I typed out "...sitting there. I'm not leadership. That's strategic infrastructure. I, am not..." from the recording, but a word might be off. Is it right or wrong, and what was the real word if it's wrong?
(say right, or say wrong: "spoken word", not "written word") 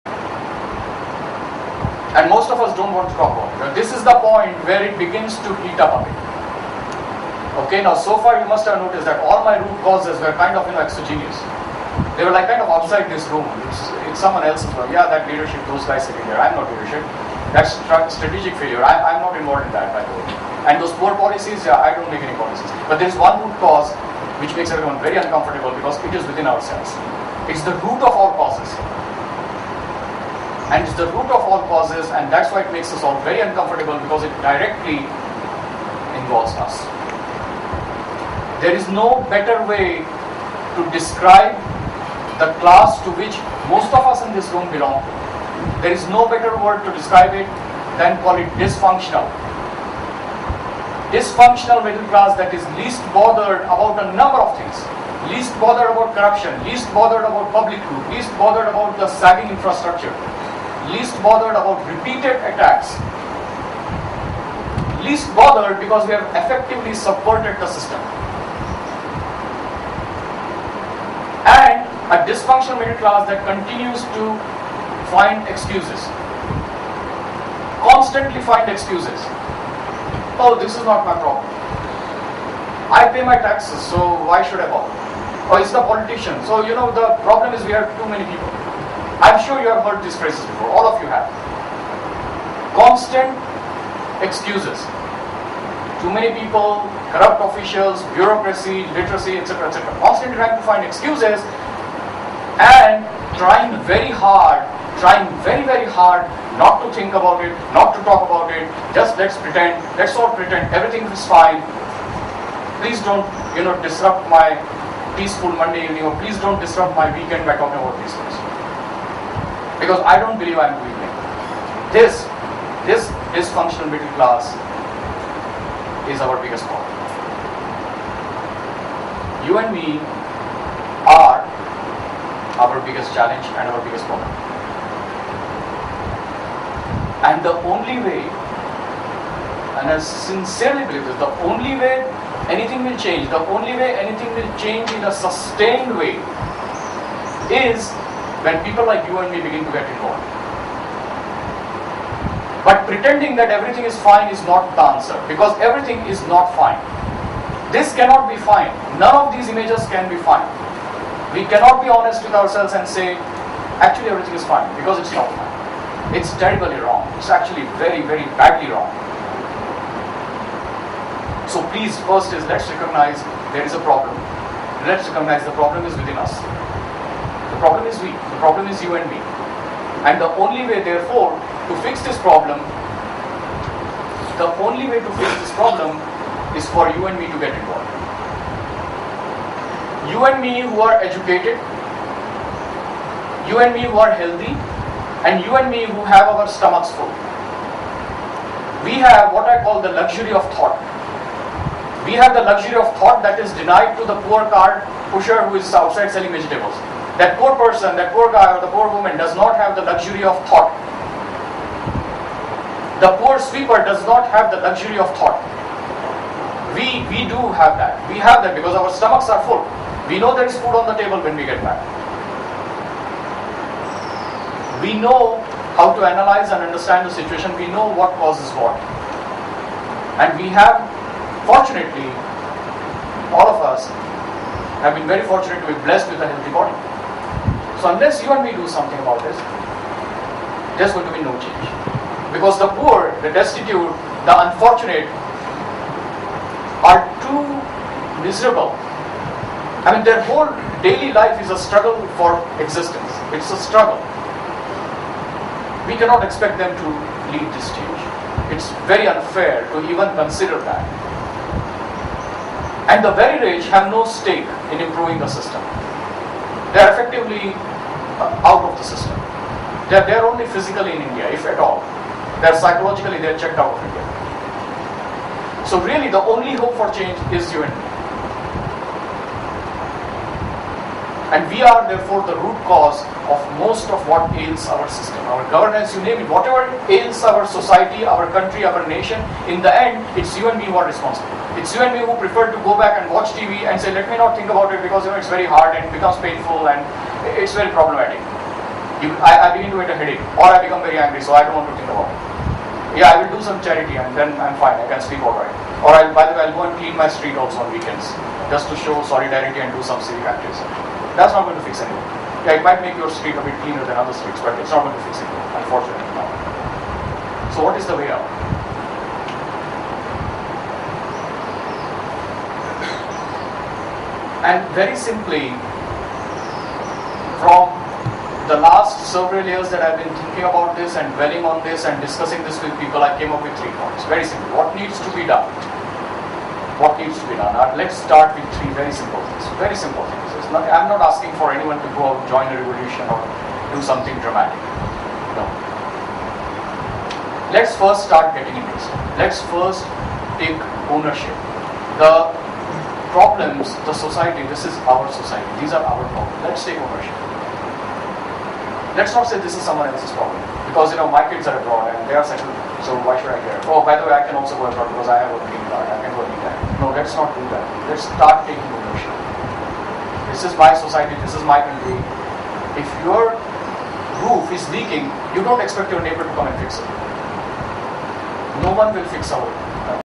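wrong: "failure", not "infrastructure".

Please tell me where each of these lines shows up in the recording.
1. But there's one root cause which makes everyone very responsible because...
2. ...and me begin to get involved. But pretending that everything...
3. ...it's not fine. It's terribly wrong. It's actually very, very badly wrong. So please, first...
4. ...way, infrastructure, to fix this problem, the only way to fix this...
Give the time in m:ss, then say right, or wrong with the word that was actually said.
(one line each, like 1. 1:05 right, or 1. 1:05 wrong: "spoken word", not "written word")
1. 0:22 wrong: "uncomfortable", not "responsible"
2. 2:29 right
3. 2:44 right
4. 3:00 wrong: "therefore", not "infrastructure".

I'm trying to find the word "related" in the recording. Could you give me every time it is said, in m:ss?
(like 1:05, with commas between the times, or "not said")
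not said.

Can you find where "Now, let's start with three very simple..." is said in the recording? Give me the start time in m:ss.
5:37.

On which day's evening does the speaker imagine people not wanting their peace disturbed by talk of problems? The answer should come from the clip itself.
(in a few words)
Monday.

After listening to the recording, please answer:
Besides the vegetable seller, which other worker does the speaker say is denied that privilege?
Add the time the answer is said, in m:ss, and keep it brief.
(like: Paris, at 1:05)
Sweeper, at 3:33.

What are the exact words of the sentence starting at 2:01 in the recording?
This, this dysfunctional middle class is our biggest problem.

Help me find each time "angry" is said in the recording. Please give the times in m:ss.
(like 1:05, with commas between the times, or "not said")
5:00.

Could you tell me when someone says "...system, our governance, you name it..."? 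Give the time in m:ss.
4:44.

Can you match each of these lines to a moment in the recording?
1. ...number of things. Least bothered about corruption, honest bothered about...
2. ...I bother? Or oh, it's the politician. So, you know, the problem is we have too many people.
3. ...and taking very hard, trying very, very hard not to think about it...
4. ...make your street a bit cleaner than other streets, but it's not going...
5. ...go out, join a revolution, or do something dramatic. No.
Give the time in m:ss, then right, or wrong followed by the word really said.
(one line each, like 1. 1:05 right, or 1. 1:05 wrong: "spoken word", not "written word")
1. 0:54 wrong: "least", not "honest"
2. 1:24 right
3. 1:42 wrong: "trying", not "taking"
4. 5:12 right
5. 5:41 right.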